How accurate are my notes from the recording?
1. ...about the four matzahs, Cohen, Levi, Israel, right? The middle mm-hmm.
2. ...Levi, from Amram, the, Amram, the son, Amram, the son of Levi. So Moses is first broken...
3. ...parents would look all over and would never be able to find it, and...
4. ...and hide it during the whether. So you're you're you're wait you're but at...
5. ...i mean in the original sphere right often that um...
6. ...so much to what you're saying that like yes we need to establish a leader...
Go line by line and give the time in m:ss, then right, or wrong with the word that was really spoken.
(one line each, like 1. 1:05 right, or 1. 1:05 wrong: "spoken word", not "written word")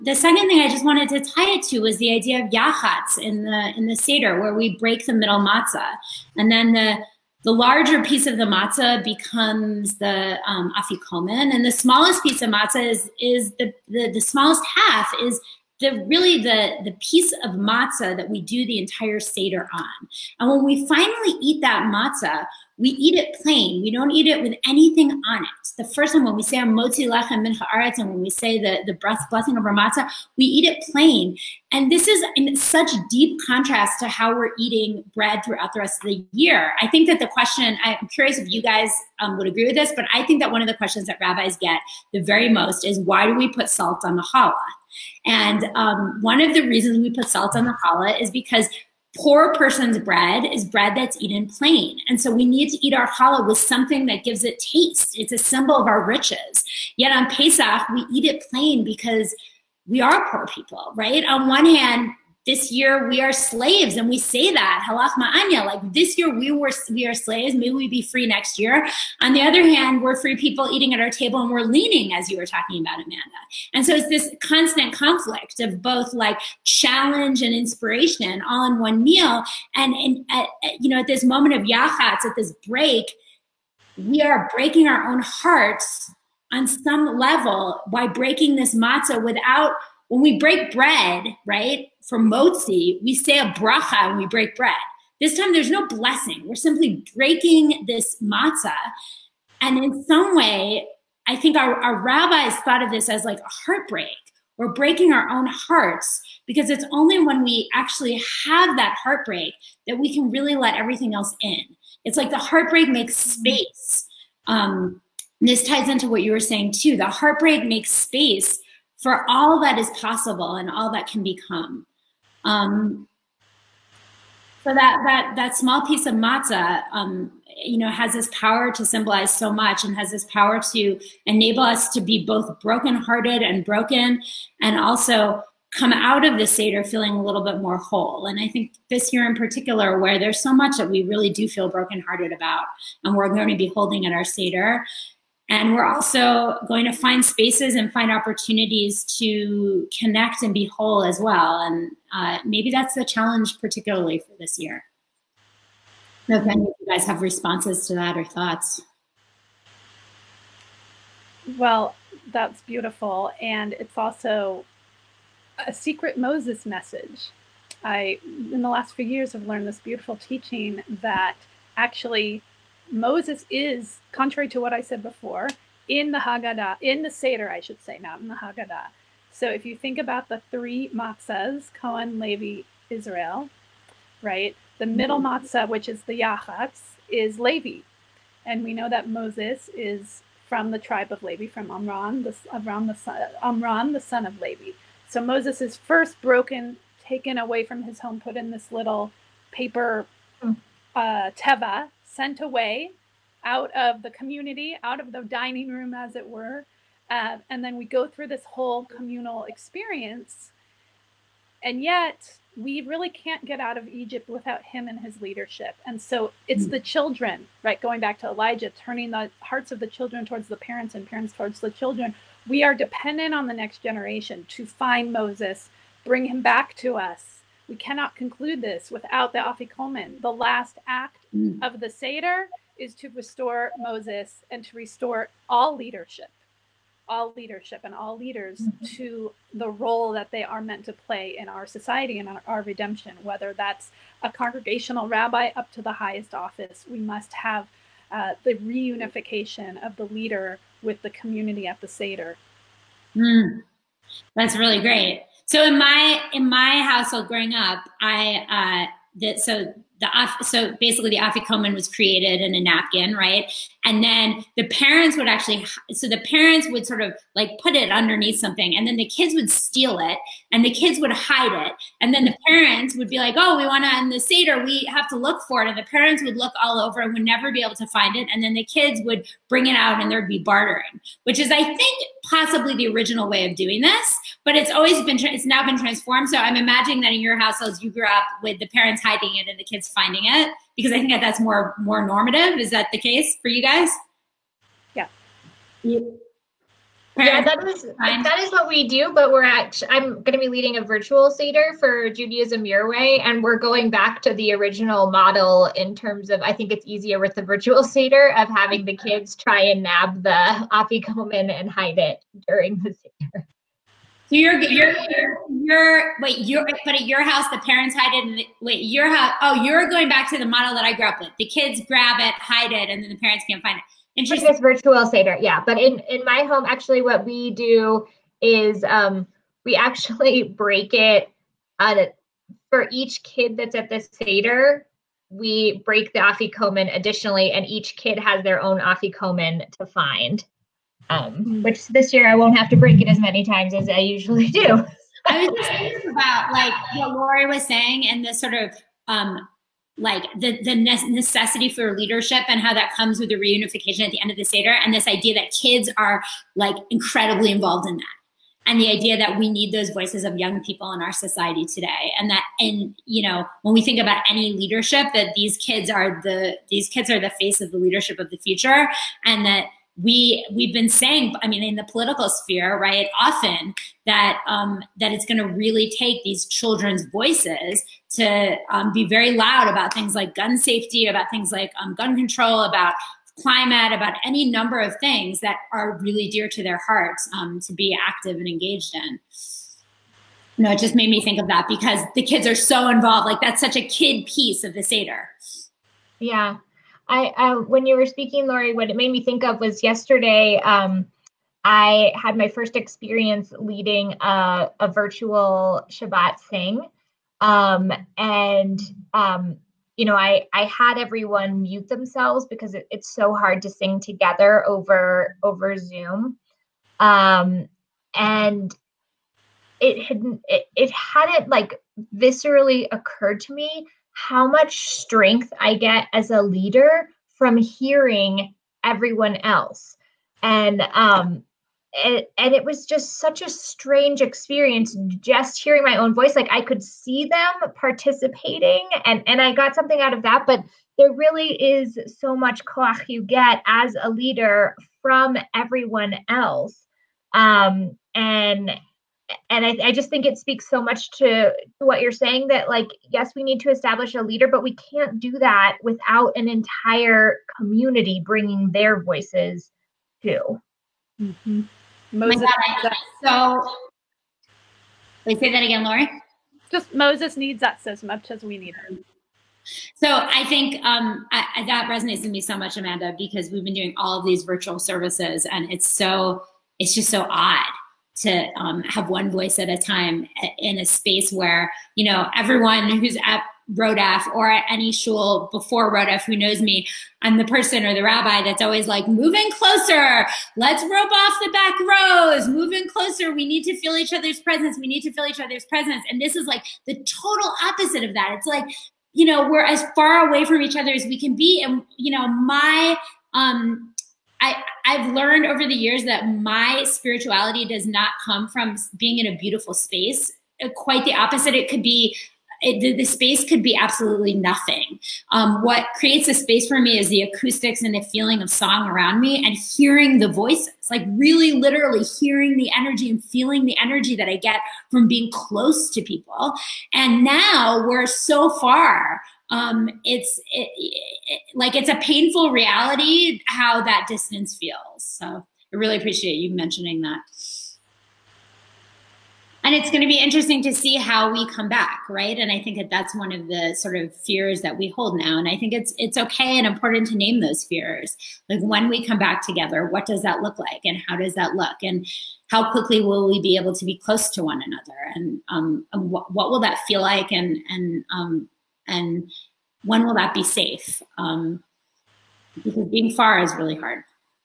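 1. 2:59 wrong: "three", not "four"
2. 3:11 right
3. 4:35 right
4. 5:11 wrong: "seder", not "whether"
5. 6:11 wrong: "political", not "original"
6. 7:30 right.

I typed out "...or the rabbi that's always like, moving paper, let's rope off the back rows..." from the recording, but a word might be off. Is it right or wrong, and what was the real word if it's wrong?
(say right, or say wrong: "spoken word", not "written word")
wrong: "closer", not "paper".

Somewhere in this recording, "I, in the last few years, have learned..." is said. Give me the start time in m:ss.
2:47.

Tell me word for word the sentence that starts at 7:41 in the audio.
Oh Moses, God, so they say that again Lori.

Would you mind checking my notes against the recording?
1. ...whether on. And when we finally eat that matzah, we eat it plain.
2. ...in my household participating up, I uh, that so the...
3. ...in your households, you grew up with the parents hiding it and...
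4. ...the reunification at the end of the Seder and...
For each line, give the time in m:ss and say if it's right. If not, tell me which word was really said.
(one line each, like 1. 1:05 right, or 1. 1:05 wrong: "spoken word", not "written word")
1. 0:19 wrong: "seder", not "whether"
2. 4:16 wrong: "growing", not "participating"
3. 4:47 right
4. 5:53 right.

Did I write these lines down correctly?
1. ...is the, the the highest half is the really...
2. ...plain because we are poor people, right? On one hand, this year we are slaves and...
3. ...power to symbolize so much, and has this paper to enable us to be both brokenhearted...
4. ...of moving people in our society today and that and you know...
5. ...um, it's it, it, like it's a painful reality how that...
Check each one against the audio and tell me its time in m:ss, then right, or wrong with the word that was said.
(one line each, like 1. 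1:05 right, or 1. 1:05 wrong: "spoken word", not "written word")
1. 0:13 wrong: "smallest", not "highest"
2. 0:58 right
3. 2:08 wrong: "power", not "paper"
4. 6:00 wrong: "young", not "moving"
5. 8:49 right.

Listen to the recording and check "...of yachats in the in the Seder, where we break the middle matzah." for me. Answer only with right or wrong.
right.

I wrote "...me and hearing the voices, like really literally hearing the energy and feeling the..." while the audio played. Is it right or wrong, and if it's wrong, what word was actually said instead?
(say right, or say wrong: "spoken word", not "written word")
right.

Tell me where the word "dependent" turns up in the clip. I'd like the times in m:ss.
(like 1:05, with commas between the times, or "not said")
3:42.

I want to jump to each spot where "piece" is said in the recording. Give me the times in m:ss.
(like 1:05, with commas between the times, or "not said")
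0:08, 0:12, 0:16, 2:05, 6:34.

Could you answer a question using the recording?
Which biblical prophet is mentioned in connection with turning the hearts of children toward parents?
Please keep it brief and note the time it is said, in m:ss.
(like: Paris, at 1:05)
Elijah, at 3:38.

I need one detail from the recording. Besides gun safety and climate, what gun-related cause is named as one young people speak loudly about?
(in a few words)
Gun control.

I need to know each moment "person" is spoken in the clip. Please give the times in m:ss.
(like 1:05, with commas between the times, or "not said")
0:49, 8:07.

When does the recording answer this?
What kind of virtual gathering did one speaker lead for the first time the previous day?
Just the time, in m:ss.
6:45.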